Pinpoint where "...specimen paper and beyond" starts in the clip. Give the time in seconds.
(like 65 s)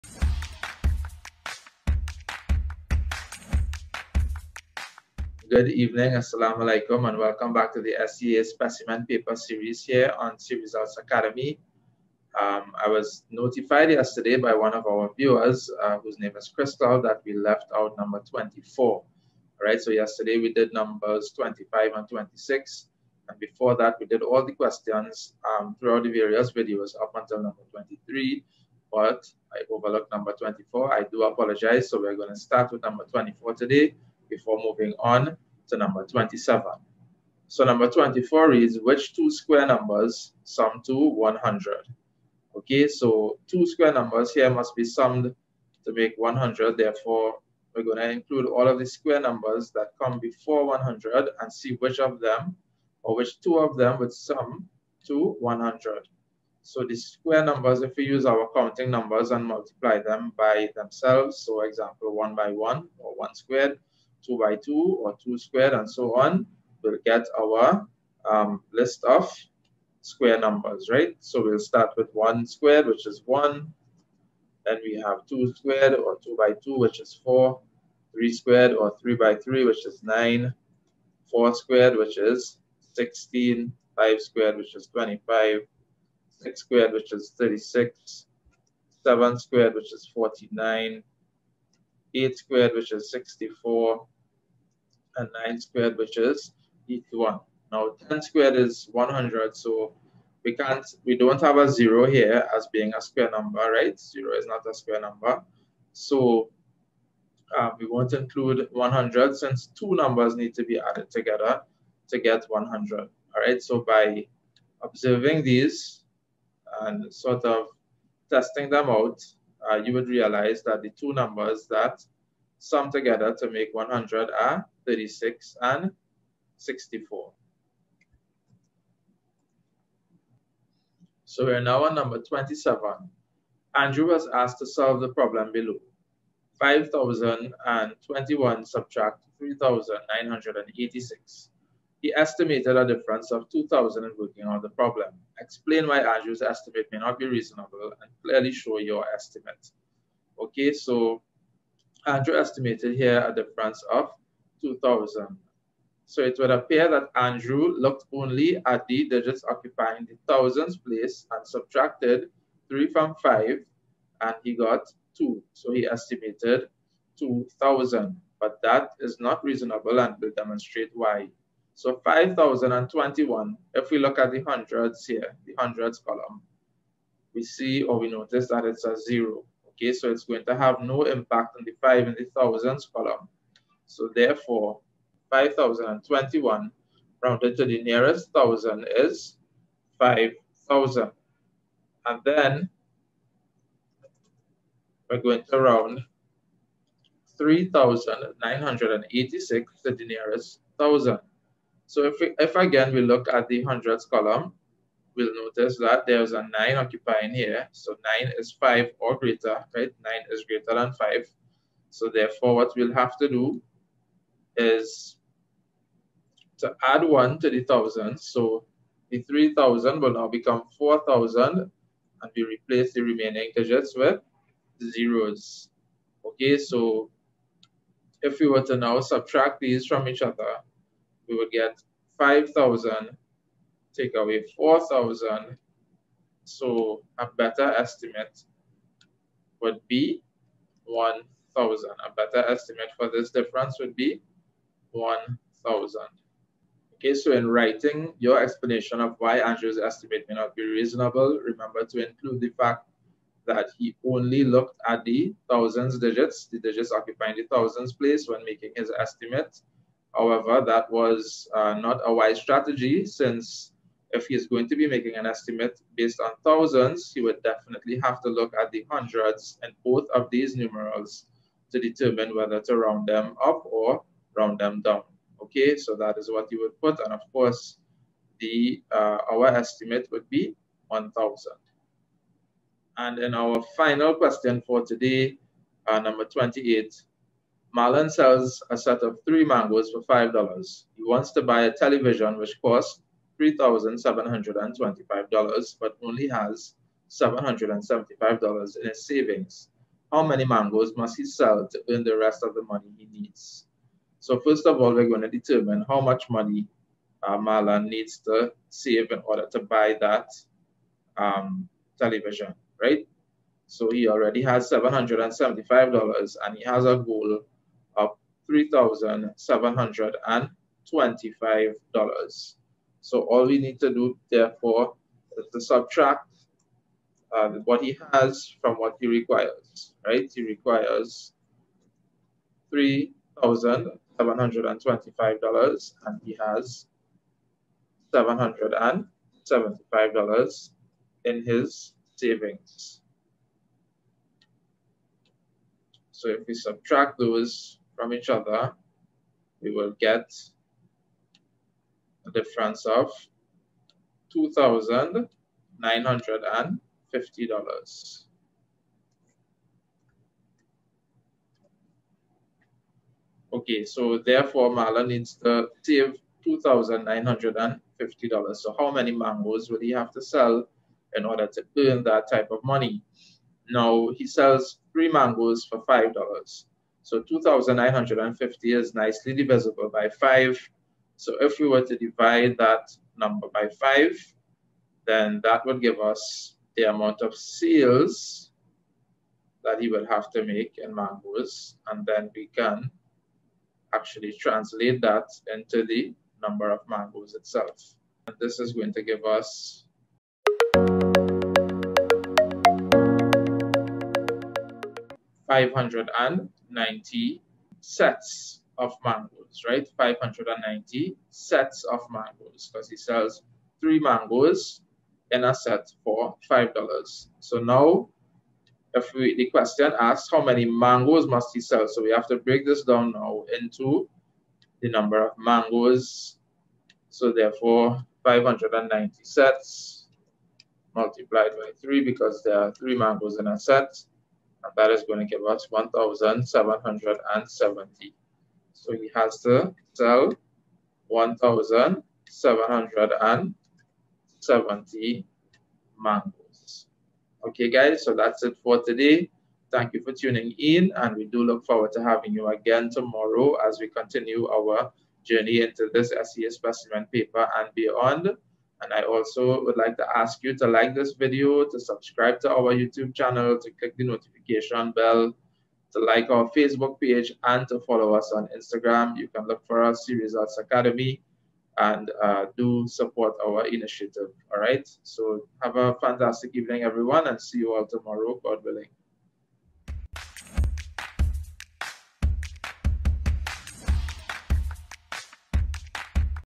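456 s.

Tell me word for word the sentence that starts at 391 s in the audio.
And then we can actually translate that into the number of mangoes itself.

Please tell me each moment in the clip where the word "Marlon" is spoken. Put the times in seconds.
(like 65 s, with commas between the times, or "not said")
287 s, 307 s, 364 s.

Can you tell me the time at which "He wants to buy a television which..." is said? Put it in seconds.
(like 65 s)
290 s.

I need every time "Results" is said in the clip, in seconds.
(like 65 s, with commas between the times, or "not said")
10 s, 470 s.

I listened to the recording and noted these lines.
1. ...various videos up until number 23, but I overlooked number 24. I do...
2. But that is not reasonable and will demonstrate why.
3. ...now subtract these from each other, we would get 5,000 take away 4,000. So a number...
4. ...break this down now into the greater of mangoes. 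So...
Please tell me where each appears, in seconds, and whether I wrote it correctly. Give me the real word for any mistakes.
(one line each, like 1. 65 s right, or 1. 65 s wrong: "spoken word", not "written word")
1. 26 s right
2. 168 s right
3. 228 s wrong: "better", not "number"
4. 422 s wrong: "number", not "greater".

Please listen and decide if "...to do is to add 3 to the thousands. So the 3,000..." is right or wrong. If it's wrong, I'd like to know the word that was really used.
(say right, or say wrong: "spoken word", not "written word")
wrong: "1", not "3".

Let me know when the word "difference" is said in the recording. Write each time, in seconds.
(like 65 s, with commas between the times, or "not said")
142 s, 153 s, 243 s, 352 s.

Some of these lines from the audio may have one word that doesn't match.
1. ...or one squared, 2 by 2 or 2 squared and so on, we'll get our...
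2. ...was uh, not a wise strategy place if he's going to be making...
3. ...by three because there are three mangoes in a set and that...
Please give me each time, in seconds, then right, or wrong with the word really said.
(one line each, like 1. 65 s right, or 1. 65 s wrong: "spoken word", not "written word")
1. 62 s right
2. 260 s wrong: "since", not "place"
3. 431 s right.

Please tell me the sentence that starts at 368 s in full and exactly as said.
So how many mangoes would he have to sell in order to earn that type of money?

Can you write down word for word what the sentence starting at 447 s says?
Okay, guys, so that's it for today.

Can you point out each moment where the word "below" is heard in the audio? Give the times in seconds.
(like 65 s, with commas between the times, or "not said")
135 s.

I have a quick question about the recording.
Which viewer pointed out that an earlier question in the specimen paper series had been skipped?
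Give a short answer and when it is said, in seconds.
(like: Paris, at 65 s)
Crystal, at 16 s.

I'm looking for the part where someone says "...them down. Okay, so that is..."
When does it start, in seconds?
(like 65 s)
274 s.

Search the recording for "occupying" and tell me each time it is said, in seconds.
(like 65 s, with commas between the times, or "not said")
159 s, 206 s, 256 s.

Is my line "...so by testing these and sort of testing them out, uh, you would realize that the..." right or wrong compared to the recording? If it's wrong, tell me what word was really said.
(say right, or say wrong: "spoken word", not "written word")
wrong: "observing", not "testing".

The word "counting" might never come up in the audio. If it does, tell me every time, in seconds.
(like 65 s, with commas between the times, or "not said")
58 s.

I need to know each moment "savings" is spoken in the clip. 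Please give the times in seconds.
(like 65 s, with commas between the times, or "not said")
299 s, 342 s.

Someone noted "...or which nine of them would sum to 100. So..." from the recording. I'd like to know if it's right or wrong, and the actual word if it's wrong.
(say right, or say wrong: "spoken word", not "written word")
wrong: "two", not "nine".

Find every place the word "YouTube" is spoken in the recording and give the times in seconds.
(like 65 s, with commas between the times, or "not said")
462 s.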